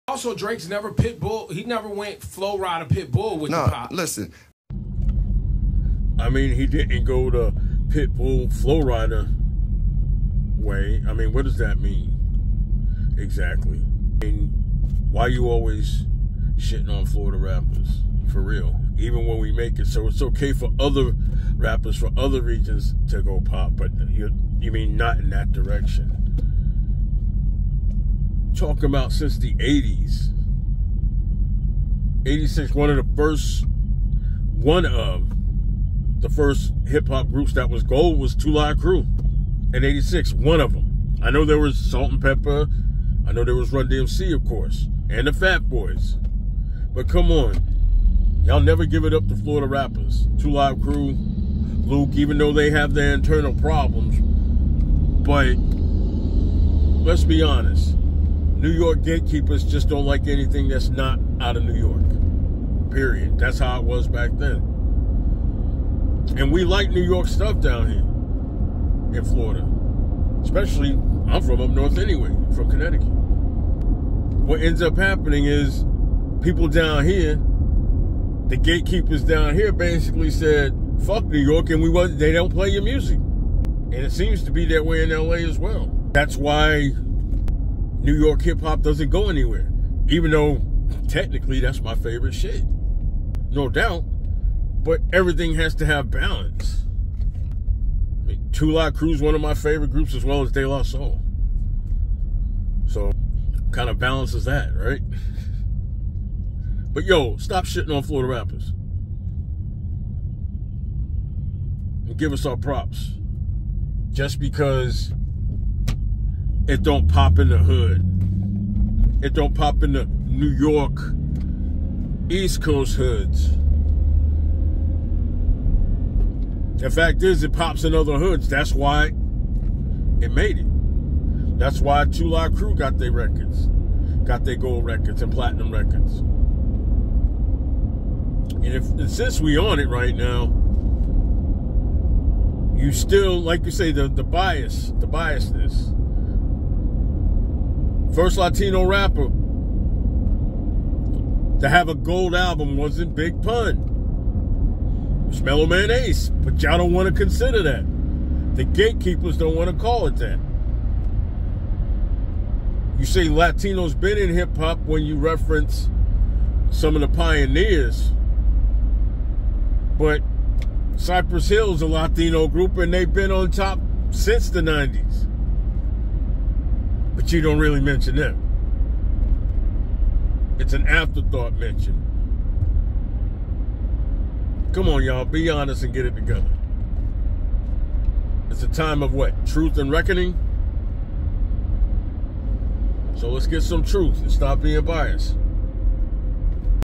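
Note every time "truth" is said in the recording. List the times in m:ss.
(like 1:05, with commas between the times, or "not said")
3:09, 3:13.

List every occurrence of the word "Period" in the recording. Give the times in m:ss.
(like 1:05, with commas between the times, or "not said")
1:02.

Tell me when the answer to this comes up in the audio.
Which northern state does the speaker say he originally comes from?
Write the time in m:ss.
1:12.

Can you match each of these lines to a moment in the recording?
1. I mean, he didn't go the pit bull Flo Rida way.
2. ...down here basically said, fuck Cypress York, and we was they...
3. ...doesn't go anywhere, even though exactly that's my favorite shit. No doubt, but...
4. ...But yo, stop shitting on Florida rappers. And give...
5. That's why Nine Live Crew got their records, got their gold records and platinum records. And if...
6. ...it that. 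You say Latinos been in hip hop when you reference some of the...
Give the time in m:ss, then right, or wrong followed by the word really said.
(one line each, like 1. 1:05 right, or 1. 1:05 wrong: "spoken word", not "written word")
1. 0:06 right
2. 1:19 wrong: "New", not "Cypress"
3. 1:28 wrong: "technically", not "exactly"
4. 1:46 right
5. 2:11 wrong: "Two", not "Nine"
6. 2:40 right.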